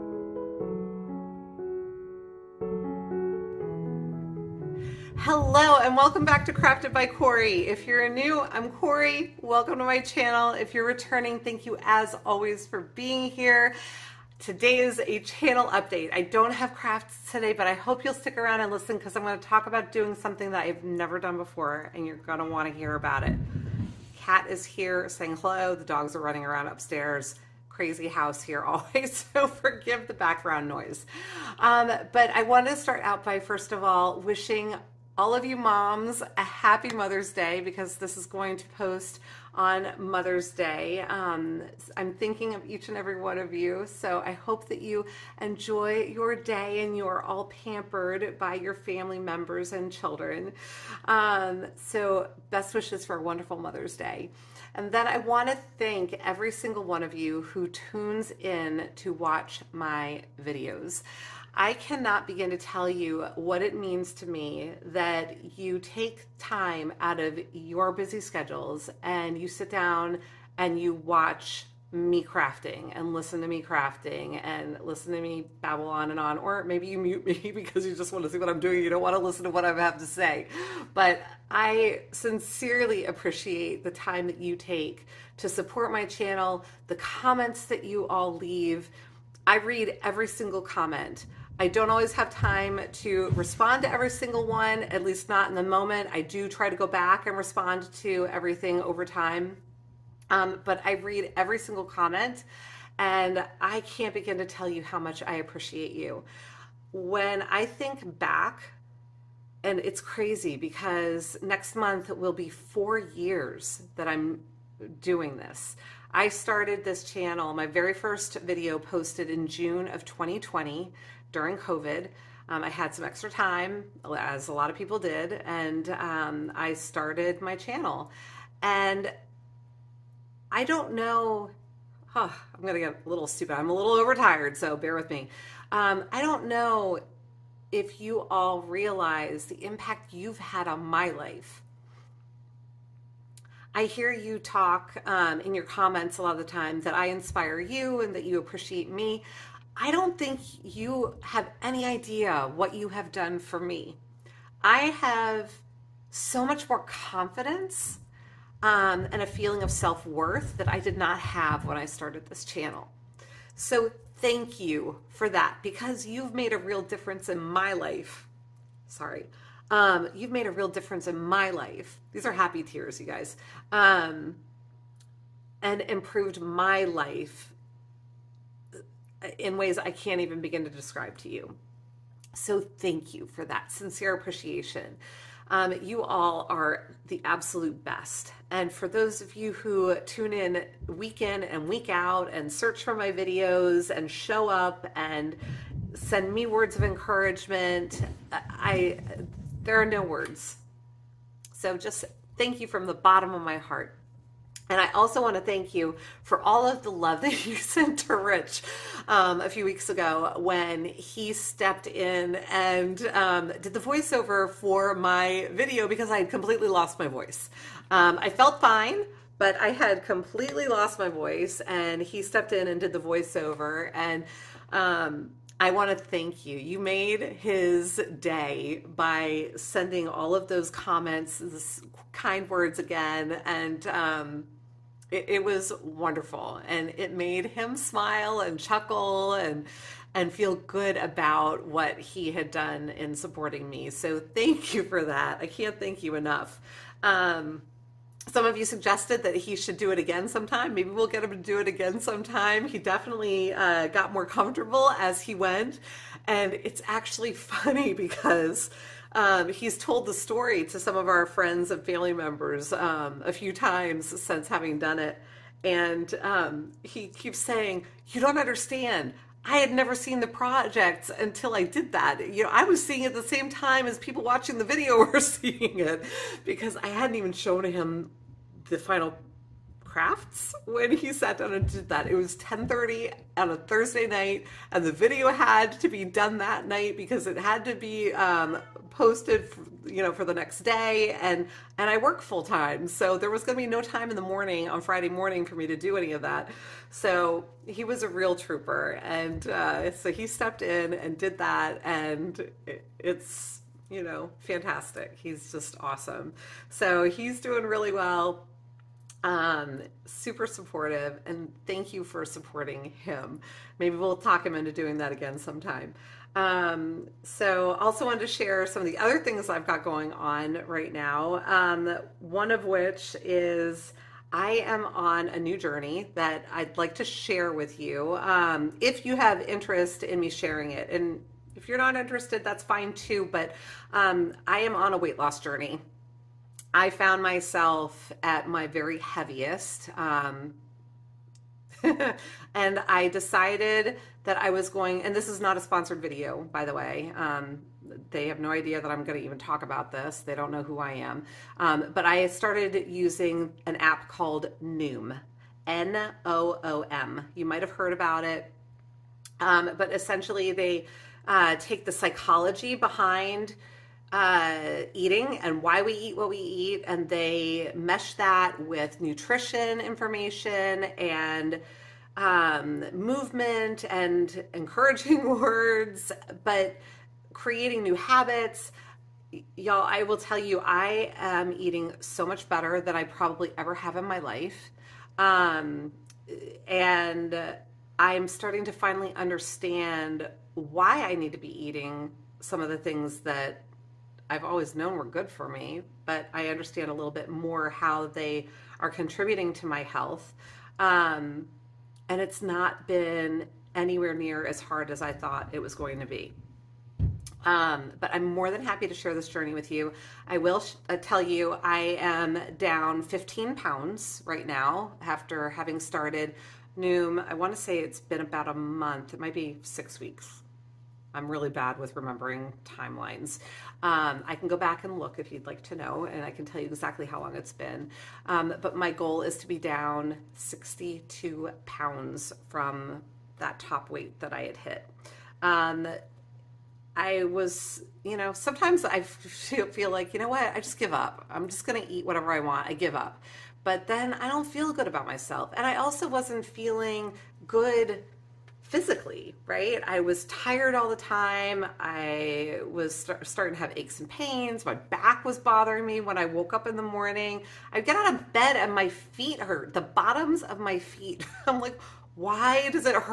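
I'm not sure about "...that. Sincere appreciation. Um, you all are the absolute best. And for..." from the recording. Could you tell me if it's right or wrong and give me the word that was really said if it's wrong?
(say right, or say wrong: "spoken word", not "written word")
right.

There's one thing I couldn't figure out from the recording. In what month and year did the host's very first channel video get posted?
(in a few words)
June 2020.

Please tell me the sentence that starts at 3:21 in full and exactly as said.
So just thank you from the bottom of my heart.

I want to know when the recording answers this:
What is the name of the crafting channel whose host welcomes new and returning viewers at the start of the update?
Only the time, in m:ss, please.
0:06.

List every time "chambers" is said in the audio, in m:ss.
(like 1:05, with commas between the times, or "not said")
not said.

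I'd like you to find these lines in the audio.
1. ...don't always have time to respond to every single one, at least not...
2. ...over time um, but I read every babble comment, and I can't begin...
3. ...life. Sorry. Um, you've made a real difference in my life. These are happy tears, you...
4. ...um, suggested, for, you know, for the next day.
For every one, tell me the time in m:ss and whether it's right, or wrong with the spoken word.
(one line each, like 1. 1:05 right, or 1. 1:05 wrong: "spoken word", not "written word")
1. 1:31 right
2. 1:38 wrong: "single", not "babble"
3. 2:47 right
4. 4:48 wrong: "posted", not "suggested".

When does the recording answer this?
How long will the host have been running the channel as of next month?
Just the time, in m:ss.
1:52.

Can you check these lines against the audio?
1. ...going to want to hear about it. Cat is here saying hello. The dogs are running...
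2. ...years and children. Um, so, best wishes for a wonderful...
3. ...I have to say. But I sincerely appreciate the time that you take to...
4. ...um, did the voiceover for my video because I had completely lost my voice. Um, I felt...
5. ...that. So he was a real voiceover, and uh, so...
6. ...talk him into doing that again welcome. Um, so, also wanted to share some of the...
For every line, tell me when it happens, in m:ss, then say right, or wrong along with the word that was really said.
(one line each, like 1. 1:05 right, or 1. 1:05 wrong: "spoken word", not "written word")
1. 0:22 right
2. 0:49 wrong: "members", not "years"
3. 1:19 right
4. 3:33 right
5. 4:56 wrong: "trooper", not "voiceover"
6. 5:14 wrong: "sometime", not "welcome".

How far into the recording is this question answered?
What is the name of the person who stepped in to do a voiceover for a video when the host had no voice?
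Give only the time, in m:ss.
3:28.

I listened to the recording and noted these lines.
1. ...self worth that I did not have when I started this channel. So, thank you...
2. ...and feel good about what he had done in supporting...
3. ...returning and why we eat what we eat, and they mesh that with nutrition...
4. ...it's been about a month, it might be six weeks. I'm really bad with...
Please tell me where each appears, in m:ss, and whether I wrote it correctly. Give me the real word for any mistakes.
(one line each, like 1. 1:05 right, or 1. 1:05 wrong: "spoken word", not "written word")
1. 2:39 right
2. 4:00 right
3. 6:04 wrong: "eating", not "returning"
4. 6:57 right.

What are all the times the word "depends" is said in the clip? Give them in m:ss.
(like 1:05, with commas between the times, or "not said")
not said.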